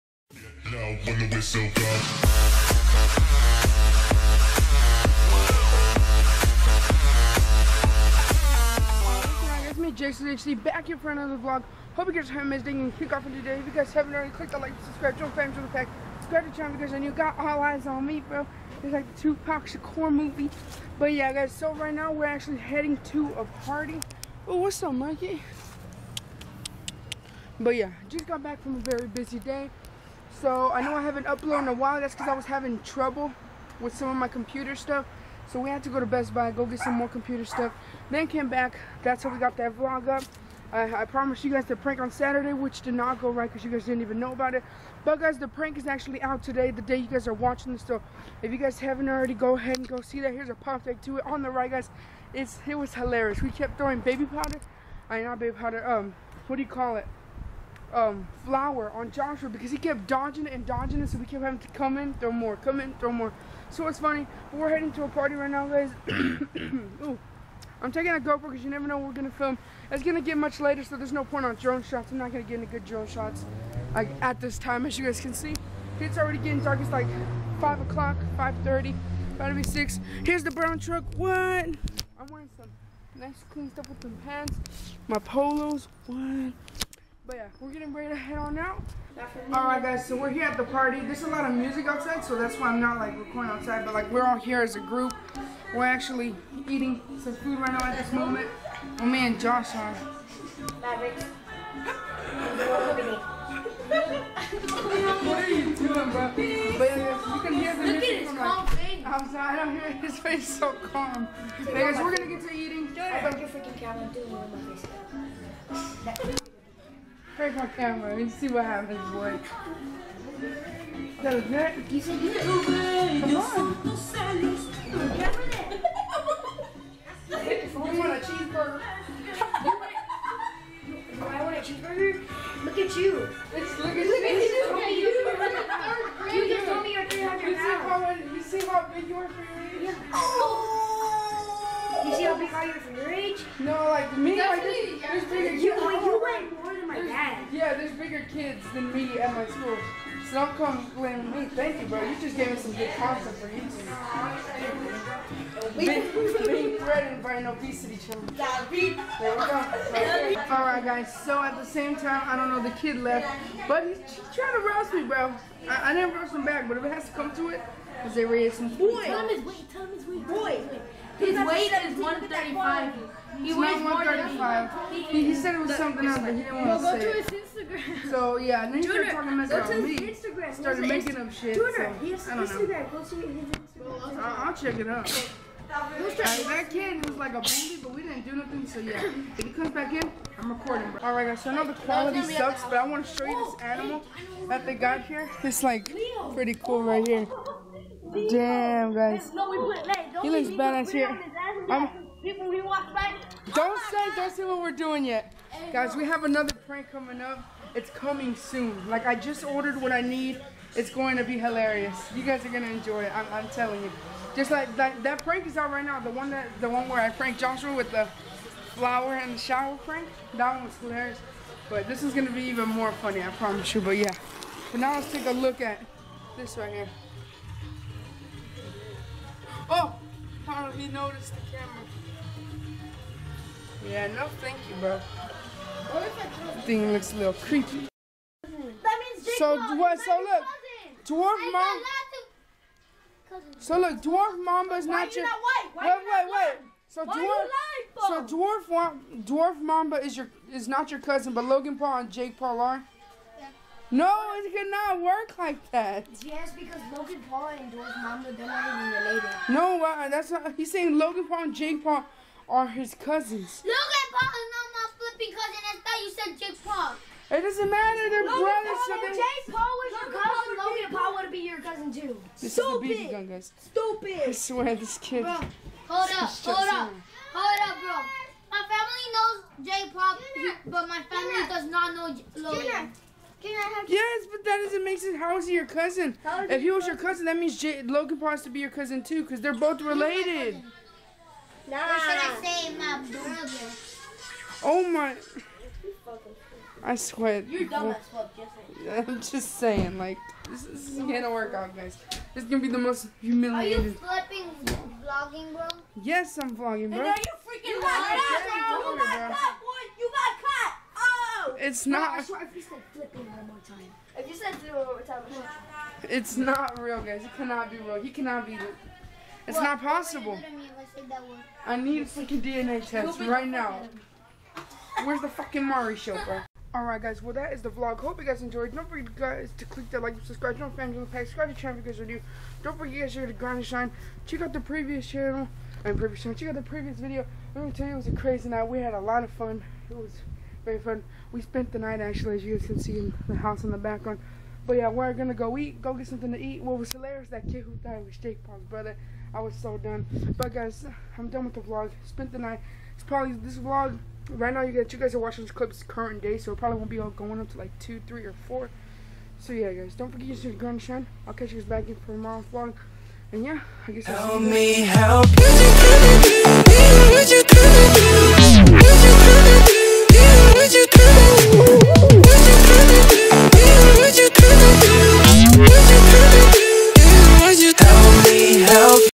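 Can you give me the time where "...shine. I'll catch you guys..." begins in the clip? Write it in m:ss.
6:00.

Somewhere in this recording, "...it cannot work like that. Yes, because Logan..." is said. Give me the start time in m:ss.
4:14.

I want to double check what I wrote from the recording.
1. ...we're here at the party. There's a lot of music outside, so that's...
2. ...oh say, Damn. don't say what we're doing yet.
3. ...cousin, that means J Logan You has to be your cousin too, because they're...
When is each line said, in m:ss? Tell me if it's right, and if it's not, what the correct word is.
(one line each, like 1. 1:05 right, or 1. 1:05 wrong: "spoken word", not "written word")
1. 1:30 right
2. 3:23 wrong: "God", not "Damn"
3. 4:46 wrong: "Paul", not "You".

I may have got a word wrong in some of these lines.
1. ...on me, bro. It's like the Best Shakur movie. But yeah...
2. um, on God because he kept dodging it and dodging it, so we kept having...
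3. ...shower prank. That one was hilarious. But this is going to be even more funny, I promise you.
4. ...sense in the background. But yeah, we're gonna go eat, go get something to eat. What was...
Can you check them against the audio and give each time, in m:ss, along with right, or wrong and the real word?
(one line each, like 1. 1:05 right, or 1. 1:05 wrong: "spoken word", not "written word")
1. 0:17 wrong: "Tupac", not "Best"
2. 0:57 wrong: "Joshua", not "God"
3. 3:39 right
4. 5:43 wrong: "house", not "sense".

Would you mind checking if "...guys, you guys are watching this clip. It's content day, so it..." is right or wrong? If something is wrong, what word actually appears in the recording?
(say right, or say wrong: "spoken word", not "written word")
wrong: "current", not "content".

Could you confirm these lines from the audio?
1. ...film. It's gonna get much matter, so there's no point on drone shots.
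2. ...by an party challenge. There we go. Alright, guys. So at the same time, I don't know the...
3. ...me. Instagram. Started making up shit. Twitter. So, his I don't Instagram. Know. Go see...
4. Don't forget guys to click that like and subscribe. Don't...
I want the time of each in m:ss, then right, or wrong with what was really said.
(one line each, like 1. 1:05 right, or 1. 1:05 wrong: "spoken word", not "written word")
1. 1:09 wrong: "later", not "matter"
2. 2:37 wrong: "obesity", not "party"
3. 2:59 right
4. 5:28 right.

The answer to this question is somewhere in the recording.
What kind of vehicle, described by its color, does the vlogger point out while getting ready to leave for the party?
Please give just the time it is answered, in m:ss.
1:20.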